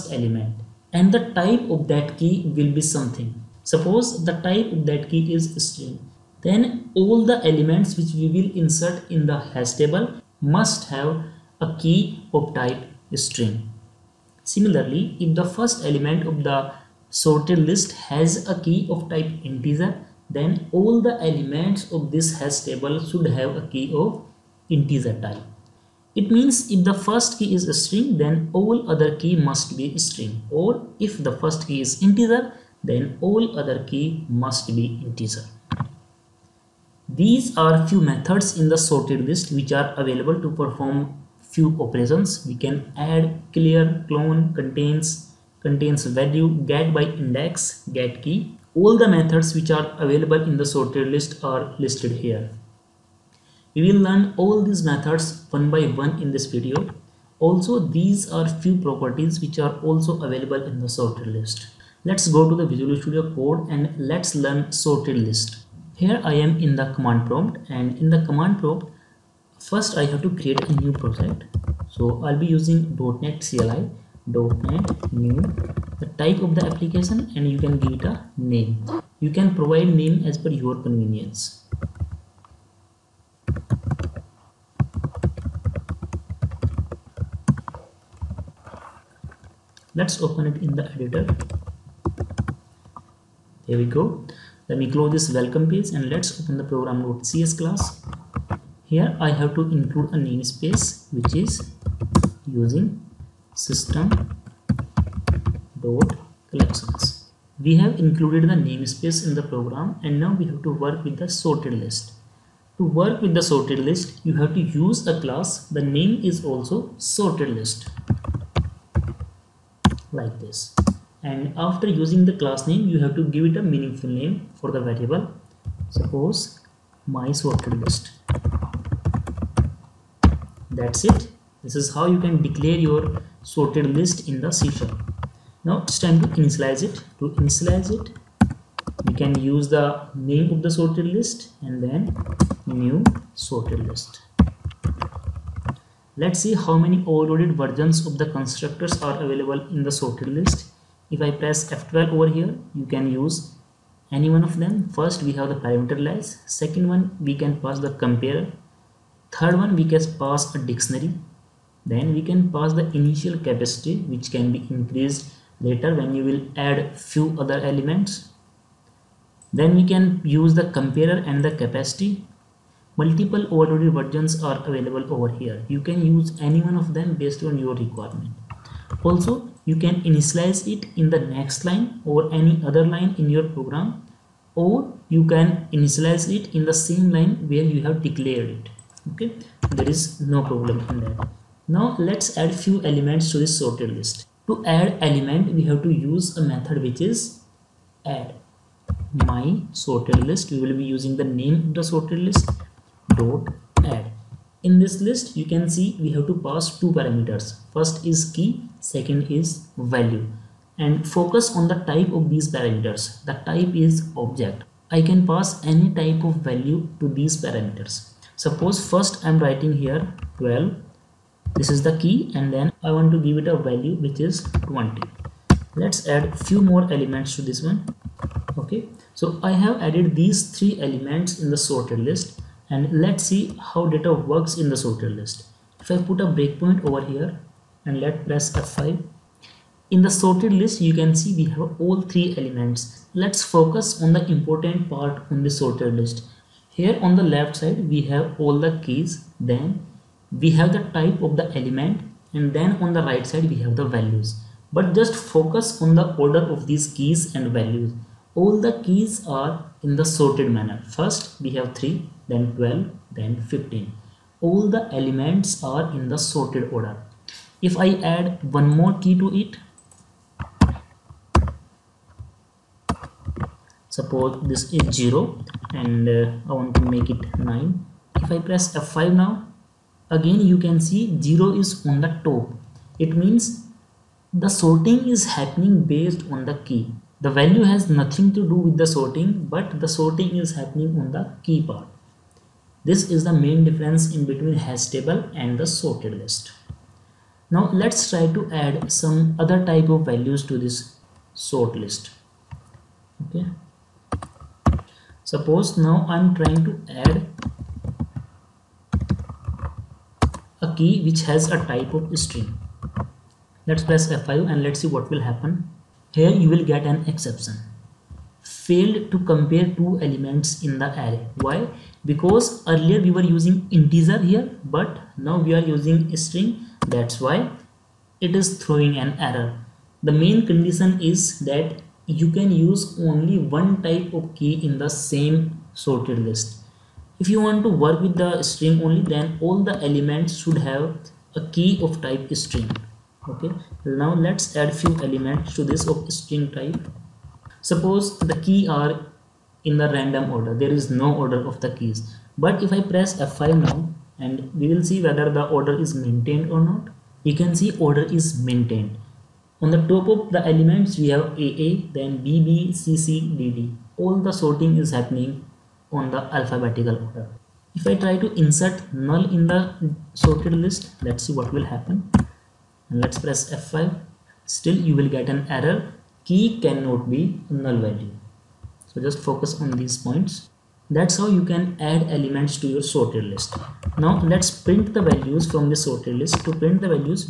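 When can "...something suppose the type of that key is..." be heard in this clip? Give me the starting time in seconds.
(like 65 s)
2 s.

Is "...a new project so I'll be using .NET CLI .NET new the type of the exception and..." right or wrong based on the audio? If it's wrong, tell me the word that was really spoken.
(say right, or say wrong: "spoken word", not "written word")
wrong: "application", not "exception".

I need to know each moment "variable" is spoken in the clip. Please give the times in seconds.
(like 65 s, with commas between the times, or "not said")
124 s.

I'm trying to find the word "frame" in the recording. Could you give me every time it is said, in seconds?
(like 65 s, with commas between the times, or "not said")
not said.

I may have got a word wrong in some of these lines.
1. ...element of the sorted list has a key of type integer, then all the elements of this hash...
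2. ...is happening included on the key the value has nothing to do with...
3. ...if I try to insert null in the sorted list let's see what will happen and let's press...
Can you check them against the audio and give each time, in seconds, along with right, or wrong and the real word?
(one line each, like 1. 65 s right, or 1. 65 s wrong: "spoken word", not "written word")
1. 15 s right
2. 285 s wrong: "based", not "included"
3. 367 s right.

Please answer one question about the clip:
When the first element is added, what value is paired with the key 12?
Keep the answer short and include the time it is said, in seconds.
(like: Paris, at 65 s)
20, at 224 s.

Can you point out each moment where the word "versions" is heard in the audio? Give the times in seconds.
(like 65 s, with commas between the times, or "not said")
147 s, 173 s.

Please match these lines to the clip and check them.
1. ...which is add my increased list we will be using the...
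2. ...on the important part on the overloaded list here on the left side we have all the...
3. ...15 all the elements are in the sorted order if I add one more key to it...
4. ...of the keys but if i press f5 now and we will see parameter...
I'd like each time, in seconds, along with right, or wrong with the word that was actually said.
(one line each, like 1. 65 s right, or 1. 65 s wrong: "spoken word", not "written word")
1. 196 s wrong: "sorted", not "increased"
2. 244 s wrong: "sorted", not "overloaded"
3. 263 s right
4. 351 s wrong: "whether", not "parameter".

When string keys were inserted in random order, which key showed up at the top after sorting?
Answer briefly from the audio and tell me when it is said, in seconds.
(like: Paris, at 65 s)
AA, at 361 s.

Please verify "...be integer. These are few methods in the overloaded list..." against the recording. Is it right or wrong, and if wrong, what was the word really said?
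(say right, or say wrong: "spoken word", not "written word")
wrong: "sorted", not "overloaded".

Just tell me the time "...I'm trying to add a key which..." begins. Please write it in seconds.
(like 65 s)
306 s.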